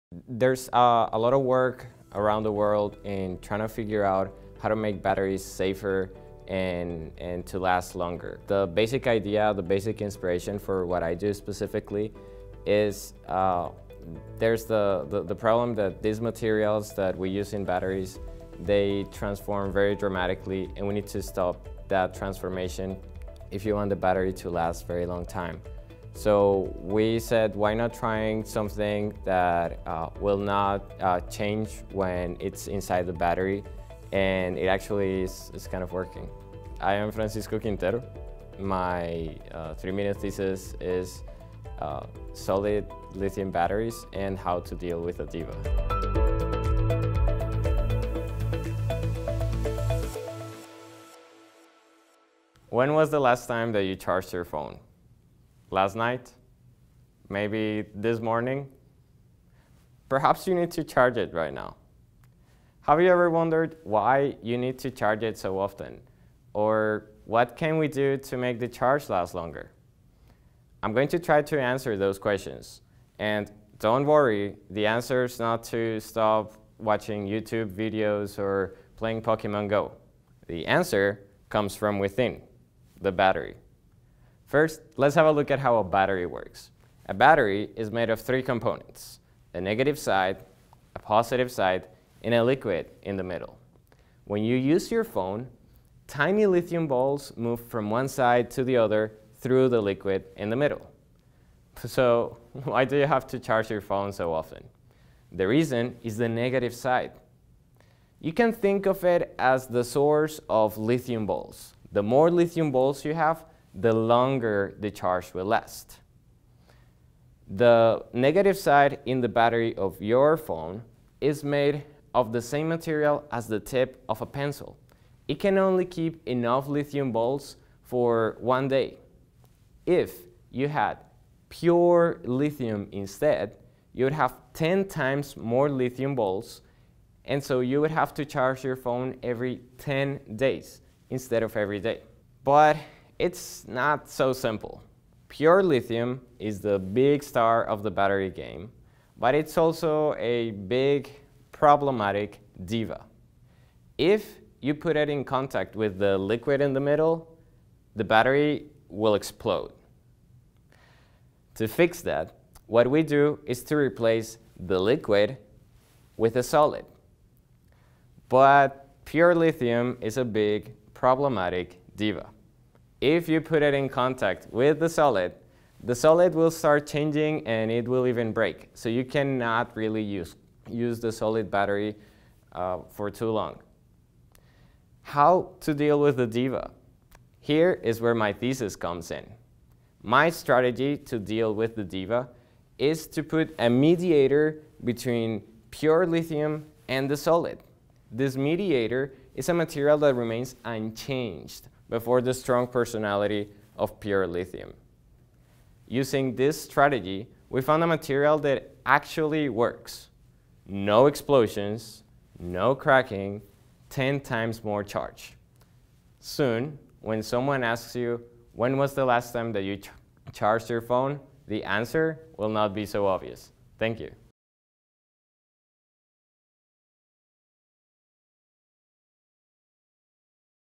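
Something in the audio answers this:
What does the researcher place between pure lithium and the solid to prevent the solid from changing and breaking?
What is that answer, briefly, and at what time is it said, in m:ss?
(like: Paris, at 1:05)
a mediator, at 3:13.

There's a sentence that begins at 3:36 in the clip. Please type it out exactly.
Soon, when someone asks you, when was the last time that you ch charged your phone?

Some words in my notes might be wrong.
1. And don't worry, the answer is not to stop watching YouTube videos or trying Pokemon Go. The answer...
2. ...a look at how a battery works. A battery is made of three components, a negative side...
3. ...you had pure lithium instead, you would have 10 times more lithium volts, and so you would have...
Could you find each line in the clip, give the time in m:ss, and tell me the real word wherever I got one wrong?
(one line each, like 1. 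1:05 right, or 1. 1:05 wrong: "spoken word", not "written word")
1. 1:13 wrong: "playing", not "trying"
2. 1:25 right
3. 2:10 right.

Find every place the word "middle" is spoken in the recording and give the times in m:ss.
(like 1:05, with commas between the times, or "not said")
1:33, 1:40, 2:36.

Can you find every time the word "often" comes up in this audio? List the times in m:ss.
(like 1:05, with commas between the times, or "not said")
1:05, 1:44.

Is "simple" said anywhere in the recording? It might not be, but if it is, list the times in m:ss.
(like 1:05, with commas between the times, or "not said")
2:24.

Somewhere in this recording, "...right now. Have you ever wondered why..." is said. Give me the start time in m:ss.
1:01.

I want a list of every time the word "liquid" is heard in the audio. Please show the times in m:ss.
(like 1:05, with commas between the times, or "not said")
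1:32, 1:39, 2:36, 2:44.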